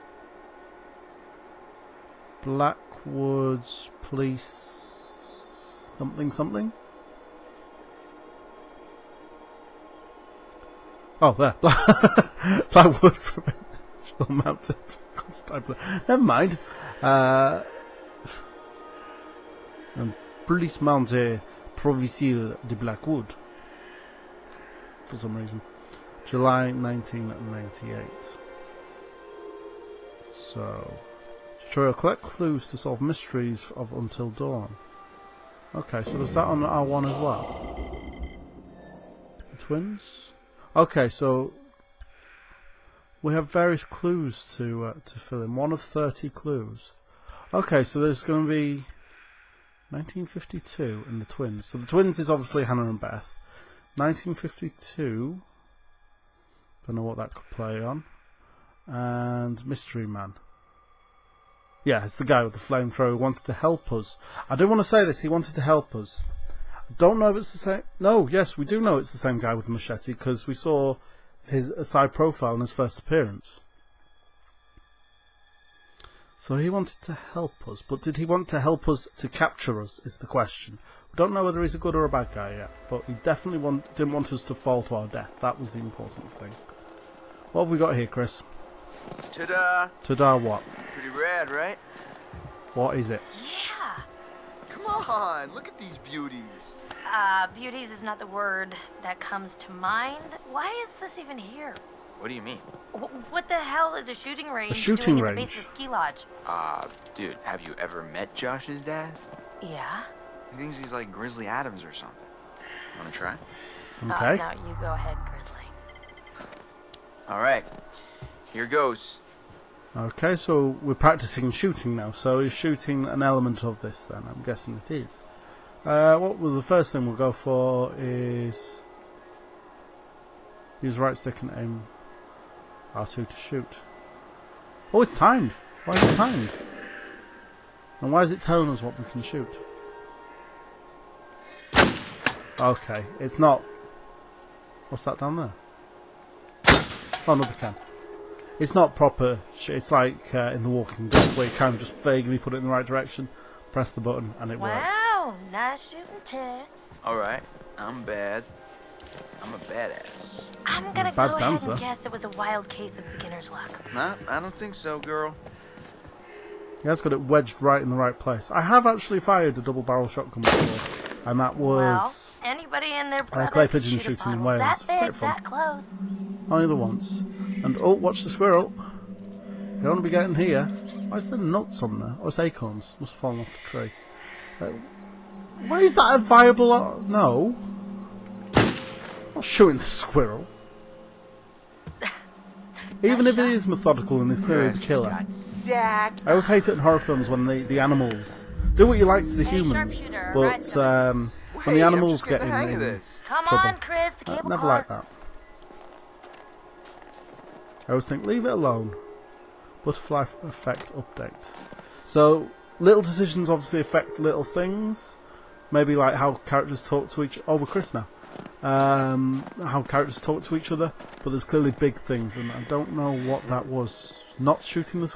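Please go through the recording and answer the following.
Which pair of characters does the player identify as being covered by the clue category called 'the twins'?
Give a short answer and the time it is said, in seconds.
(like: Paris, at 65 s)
Hannah and Beth, at 52 s.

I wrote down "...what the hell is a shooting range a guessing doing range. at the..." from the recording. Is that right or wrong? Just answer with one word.
wrong.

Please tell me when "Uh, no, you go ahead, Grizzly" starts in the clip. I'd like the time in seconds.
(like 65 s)
114 s.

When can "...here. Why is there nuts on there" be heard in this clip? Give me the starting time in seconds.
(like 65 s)
180 s.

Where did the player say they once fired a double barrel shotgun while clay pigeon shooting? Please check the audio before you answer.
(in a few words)
Wales.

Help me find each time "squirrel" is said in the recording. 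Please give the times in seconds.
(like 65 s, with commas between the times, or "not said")
178 s, 189 s.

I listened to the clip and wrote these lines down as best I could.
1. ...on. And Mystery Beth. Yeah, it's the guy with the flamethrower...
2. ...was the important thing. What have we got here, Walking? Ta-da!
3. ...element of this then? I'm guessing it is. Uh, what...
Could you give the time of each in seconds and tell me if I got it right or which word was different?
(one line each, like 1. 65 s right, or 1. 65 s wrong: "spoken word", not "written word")
1. 57 s wrong: "Man", not "Beth"
2. 85 s wrong: "Chris", not "Walking"
3. 123 s right.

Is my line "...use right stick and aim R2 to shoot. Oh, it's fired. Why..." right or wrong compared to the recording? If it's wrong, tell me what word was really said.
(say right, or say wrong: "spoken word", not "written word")
wrong: "timed", not "fired".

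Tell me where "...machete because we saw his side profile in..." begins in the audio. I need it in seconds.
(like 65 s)
69 s.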